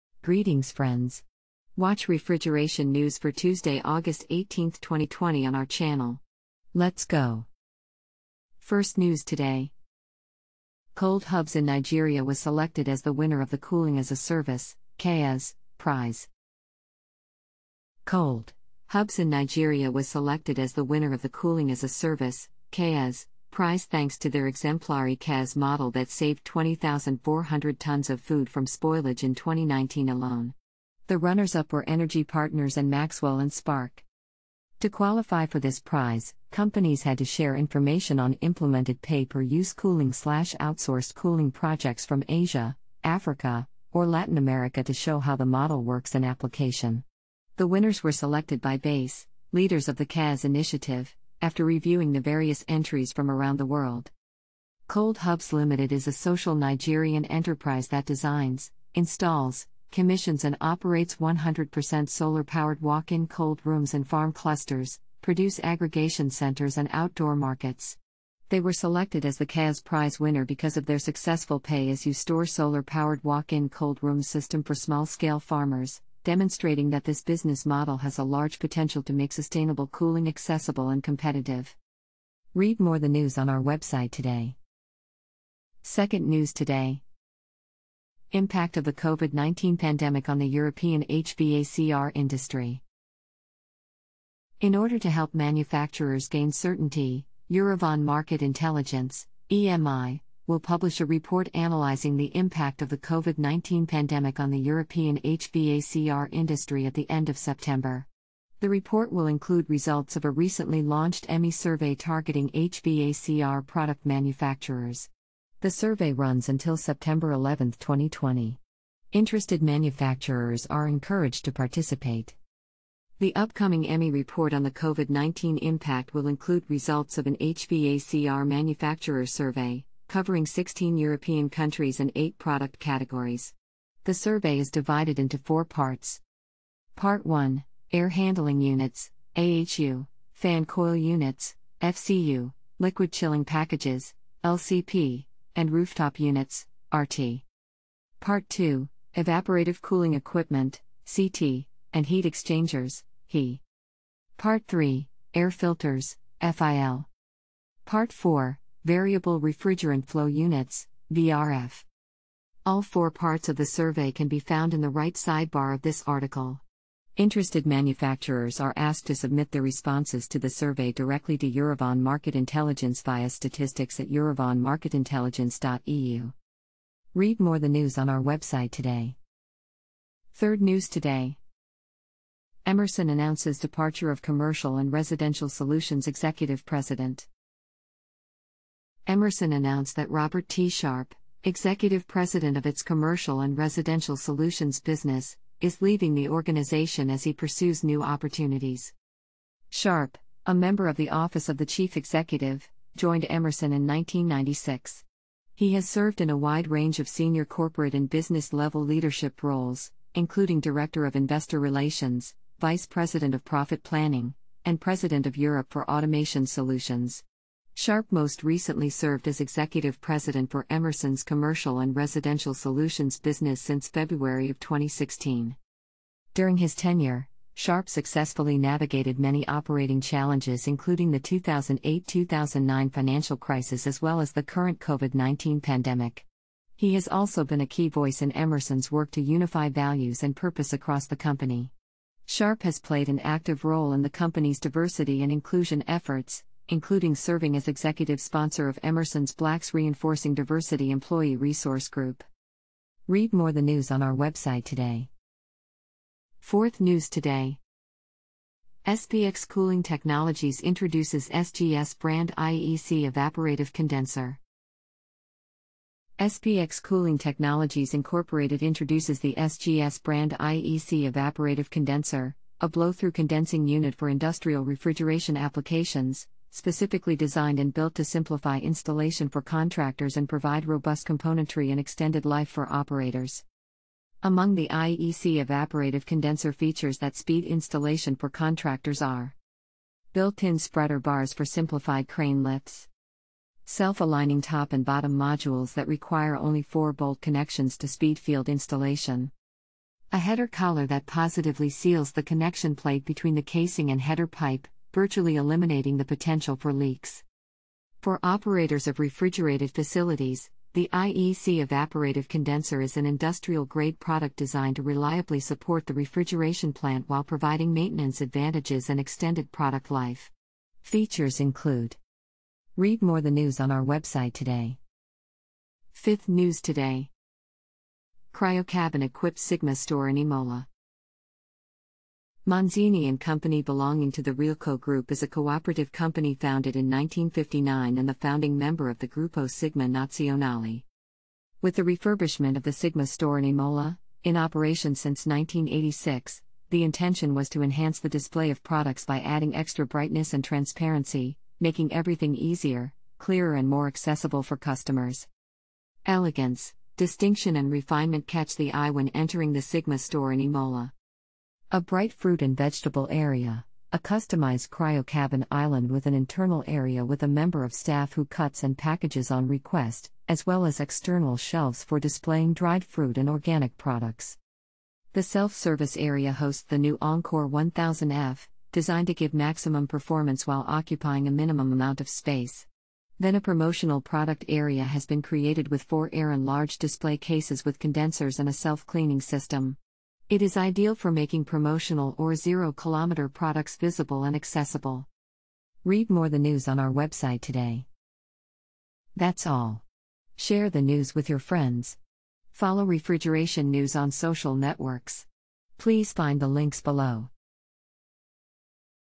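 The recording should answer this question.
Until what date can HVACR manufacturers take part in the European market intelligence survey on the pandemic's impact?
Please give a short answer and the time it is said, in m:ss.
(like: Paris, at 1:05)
September 11, 2020, at 1:56.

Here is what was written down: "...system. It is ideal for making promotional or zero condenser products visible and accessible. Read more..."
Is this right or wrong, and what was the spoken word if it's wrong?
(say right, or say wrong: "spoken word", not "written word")
wrong: "kilometer", not "condenser".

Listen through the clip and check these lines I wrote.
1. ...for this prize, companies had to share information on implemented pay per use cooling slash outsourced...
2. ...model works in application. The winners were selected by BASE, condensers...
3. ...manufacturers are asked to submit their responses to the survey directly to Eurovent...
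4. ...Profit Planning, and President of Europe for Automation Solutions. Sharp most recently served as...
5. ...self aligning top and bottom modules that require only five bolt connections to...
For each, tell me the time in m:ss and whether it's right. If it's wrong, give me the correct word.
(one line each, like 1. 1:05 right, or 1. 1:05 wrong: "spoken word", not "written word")
1. 0:35 right
2. 0:45 wrong: "leaders", not "condensers"
3. 2:47 right
4. 3:33 right
5. 4:53 wrong: "four", not "five".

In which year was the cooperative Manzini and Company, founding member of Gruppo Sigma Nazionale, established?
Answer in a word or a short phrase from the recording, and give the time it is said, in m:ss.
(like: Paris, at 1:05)
1959, at 5:36.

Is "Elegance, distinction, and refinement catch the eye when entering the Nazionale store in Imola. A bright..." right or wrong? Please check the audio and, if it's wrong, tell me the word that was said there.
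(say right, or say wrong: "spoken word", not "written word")
wrong: "Sigma", not "Nazionale".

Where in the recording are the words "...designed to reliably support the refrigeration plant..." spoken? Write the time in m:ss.
5:14.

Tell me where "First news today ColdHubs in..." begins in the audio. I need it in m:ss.
0:08.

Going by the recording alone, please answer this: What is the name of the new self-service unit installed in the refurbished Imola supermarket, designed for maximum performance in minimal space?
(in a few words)
Encore 1000F.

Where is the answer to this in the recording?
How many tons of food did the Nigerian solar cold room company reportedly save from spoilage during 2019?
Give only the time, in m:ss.
0:26.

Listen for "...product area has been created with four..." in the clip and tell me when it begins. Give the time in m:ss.
6:24.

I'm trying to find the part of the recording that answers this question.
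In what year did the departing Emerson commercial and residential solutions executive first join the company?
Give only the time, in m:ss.
3:23.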